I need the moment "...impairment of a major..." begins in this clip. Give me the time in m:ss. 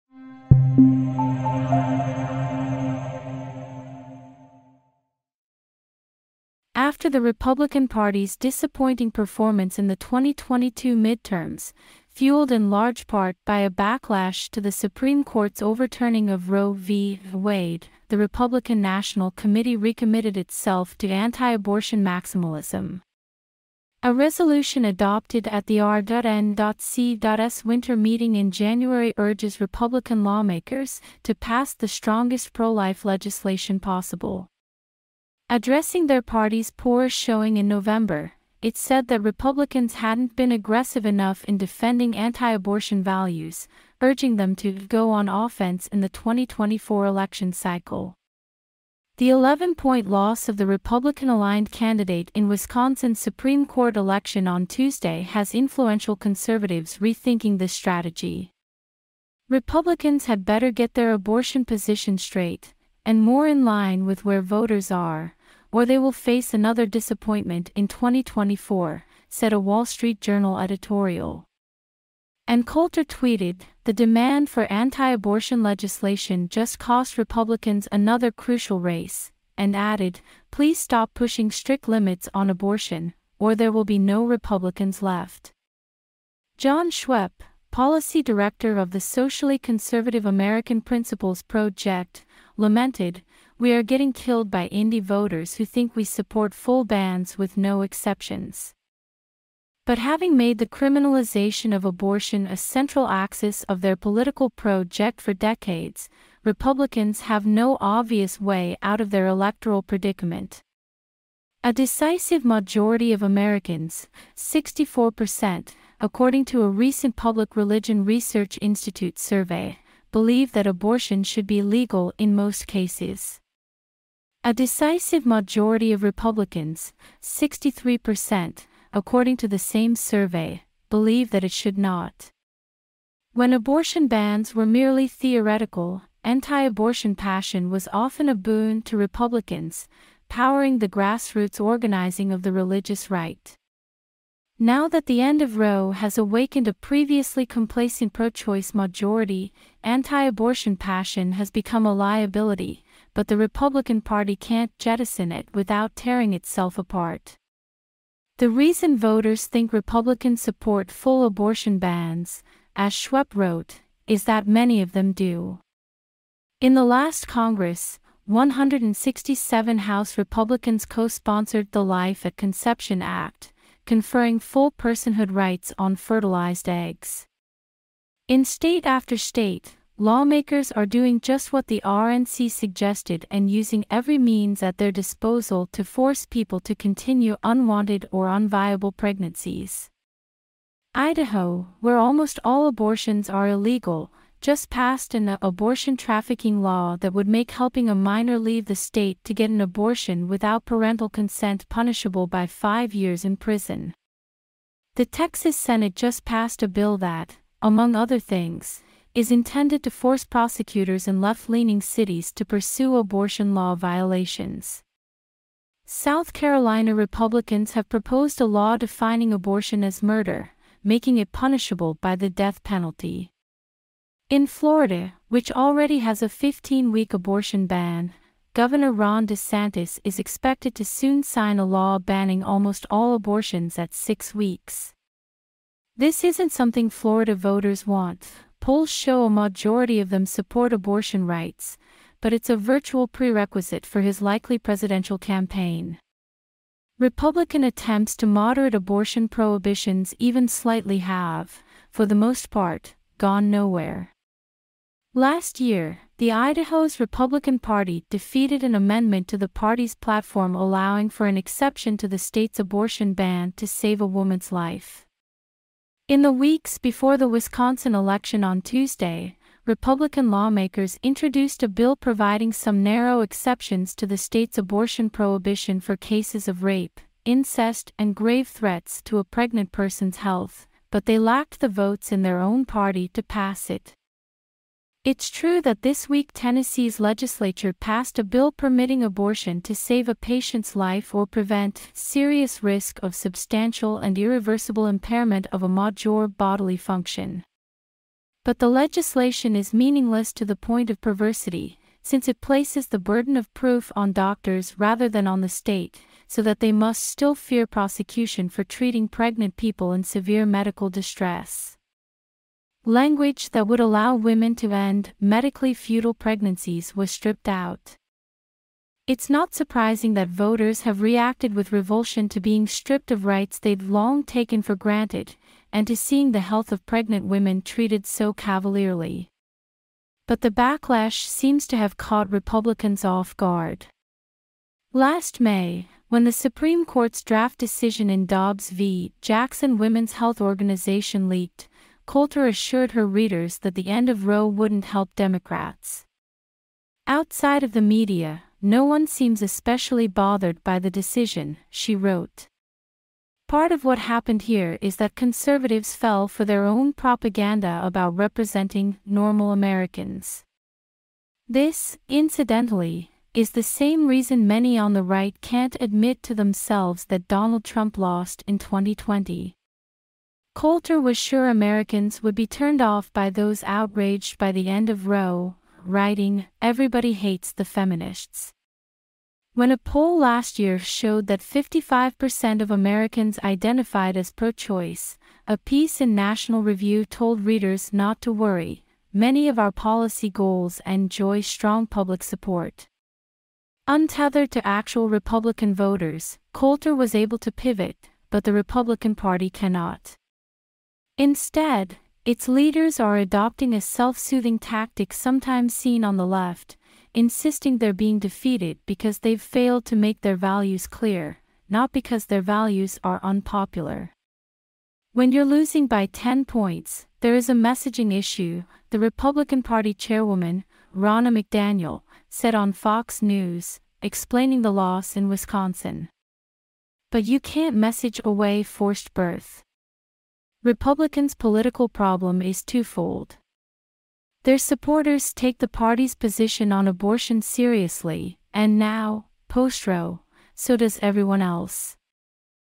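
4:54.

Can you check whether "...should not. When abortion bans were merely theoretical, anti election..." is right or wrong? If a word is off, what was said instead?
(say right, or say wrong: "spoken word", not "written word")
wrong: "abortion", not "election".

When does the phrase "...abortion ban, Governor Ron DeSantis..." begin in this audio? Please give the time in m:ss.
3:47.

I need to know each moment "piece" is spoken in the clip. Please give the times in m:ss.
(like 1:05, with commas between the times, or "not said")
6:25.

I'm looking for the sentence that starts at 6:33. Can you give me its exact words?
Untethered to actual Republican voters, Coulter was able to pivot, but the Republican Party cannot.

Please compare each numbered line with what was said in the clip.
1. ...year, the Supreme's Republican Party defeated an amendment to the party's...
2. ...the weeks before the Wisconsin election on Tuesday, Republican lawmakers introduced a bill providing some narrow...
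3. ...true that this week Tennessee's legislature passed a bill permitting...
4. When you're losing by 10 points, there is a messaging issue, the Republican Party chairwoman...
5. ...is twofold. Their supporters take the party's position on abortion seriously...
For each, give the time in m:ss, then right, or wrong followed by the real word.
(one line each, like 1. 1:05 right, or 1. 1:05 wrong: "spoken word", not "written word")
1. 4:15 wrong: "Idaho", not "Supreme"
2. 4:26 right
3. 4:45 right
4. 6:55 right
5. 7:12 right.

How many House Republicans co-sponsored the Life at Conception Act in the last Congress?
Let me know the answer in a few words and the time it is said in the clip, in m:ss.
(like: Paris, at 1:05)
167, at 2:48.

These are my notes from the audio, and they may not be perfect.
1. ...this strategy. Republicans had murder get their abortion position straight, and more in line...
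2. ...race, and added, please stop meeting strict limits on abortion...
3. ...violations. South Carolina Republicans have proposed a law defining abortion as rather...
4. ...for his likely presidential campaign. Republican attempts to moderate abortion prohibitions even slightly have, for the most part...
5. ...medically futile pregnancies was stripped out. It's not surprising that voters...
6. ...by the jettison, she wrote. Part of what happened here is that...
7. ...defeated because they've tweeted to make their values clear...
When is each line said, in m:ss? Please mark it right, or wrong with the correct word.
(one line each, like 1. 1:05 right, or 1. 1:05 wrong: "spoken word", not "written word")
1. 0:57 wrong: "better", not "murder"
2. 1:18 wrong: "pushing", not "meeting"
3. 3:33 wrong: "murder", not "rather"
4. 4:03 right
5. 5:15 right
6. 5:50 wrong: "decision", not "jettison"
7. 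6:48 wrong: "failed", not "tweeted".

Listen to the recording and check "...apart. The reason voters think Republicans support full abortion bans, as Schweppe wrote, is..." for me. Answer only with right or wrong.
right.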